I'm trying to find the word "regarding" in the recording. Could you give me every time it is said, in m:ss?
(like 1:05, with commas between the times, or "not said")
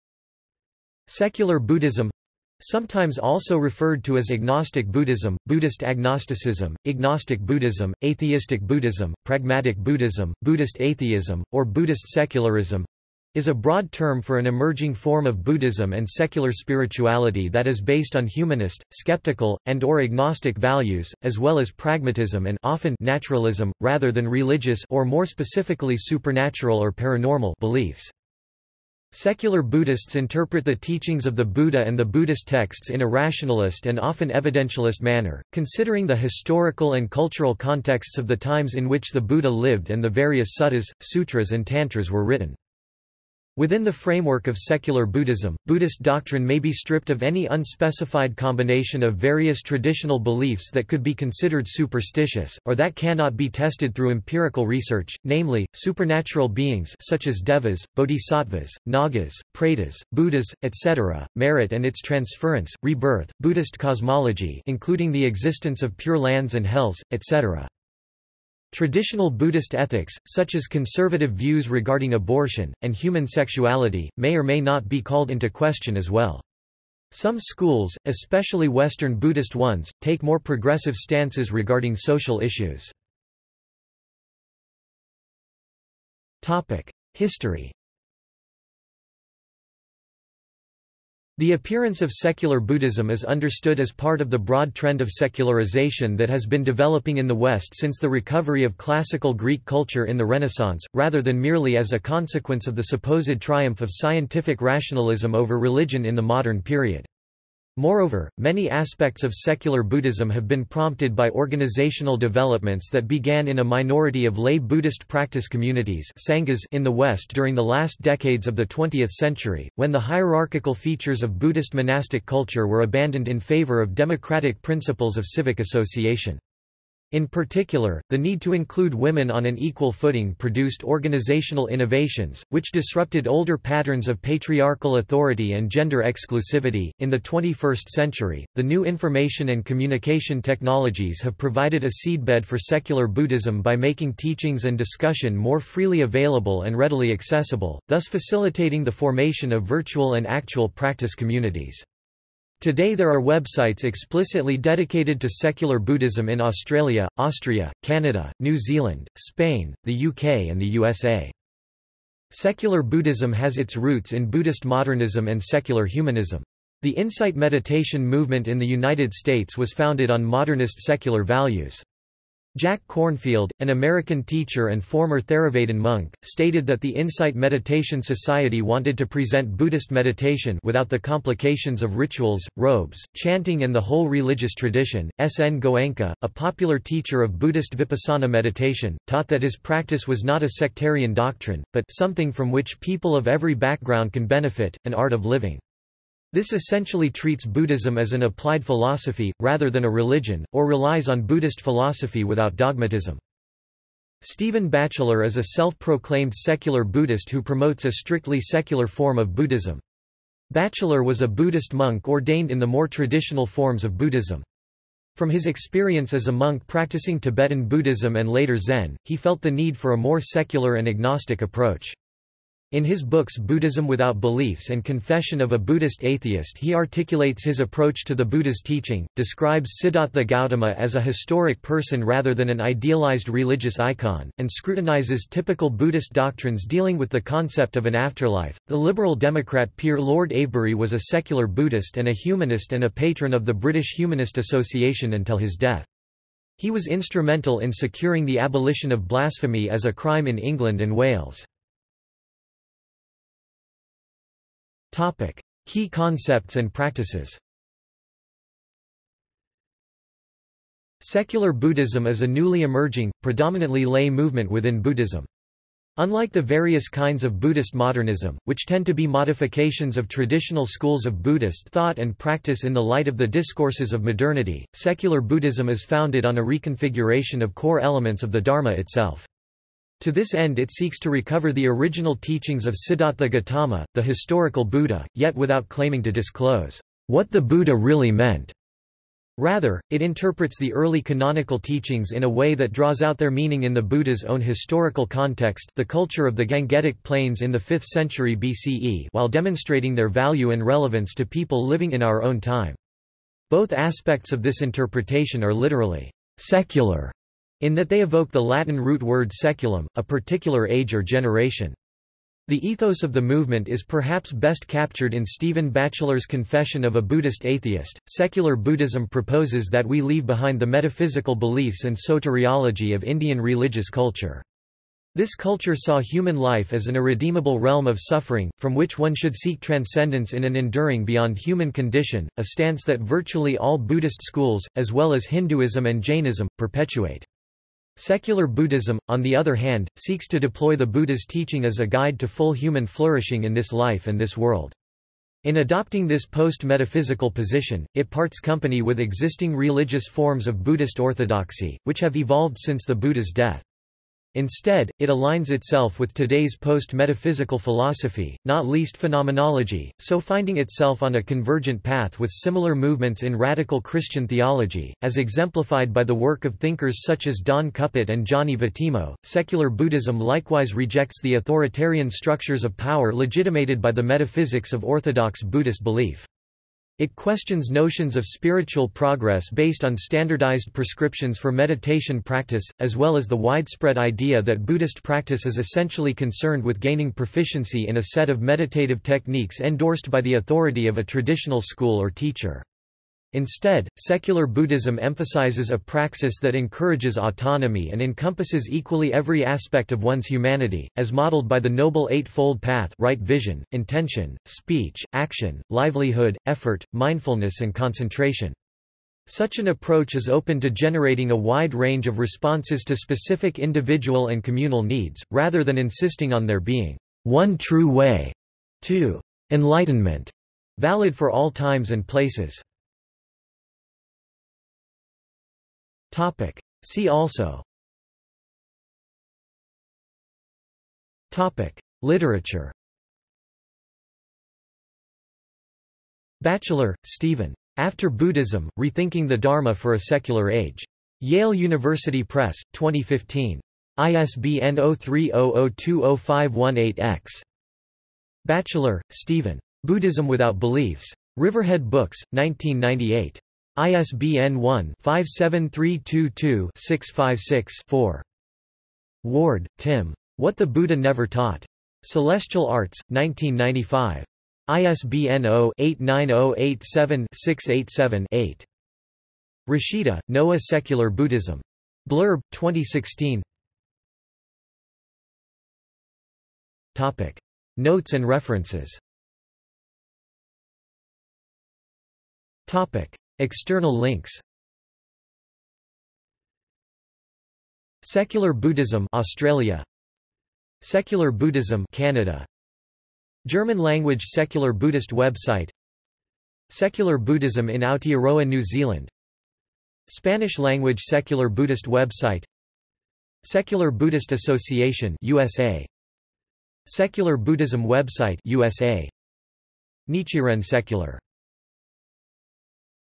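1:11, 1:21.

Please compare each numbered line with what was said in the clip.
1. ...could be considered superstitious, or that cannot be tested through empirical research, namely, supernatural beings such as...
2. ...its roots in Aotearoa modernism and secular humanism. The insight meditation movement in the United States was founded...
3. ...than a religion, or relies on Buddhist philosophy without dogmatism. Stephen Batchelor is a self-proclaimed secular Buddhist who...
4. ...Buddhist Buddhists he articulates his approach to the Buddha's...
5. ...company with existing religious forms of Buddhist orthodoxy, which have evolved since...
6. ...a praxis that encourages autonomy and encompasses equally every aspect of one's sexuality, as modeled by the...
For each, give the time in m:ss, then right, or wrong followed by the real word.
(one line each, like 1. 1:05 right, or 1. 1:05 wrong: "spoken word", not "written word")
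1. 0:50 right
2. 2:43 wrong: "Buddhist", not "Aotearoa"
3. 3:19 right
4. 3:45 wrong: "Atheist", not "Buddhists"
5. 5:48 right
6. 6:35 wrong: "humanity", not "sexuality".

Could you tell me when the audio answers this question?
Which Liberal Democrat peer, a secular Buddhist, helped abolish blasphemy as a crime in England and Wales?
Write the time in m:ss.
3:59.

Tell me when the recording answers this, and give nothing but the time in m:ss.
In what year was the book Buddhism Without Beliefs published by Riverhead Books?
7:32.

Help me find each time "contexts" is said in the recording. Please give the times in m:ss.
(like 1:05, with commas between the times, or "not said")
0:37, 4:55.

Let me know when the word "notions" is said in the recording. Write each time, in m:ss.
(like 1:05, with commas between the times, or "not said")
6:17.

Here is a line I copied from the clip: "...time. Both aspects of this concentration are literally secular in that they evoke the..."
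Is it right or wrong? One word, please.
wrong.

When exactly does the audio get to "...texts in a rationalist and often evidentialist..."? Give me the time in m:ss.
0:32.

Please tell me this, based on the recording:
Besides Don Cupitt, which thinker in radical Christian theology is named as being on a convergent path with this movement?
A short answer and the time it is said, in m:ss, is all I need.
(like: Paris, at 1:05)
Gianni Vattimo, at 6:08.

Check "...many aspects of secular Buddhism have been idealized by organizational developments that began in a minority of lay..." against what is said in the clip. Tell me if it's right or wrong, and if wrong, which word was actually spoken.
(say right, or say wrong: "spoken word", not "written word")
wrong: "prompted", not "idealized".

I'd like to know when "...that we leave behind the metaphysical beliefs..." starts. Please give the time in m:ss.
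5:19.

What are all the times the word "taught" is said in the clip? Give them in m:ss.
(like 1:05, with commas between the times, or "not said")
3:09, 7:41.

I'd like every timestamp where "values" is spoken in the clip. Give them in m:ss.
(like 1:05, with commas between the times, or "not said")
0:20, 2:51, 5:00.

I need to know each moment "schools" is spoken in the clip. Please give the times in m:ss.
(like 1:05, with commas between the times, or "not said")
1:17, 4:30, 5:34, 6:31.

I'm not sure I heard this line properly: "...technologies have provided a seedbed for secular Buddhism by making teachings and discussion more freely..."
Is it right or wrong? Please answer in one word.
right.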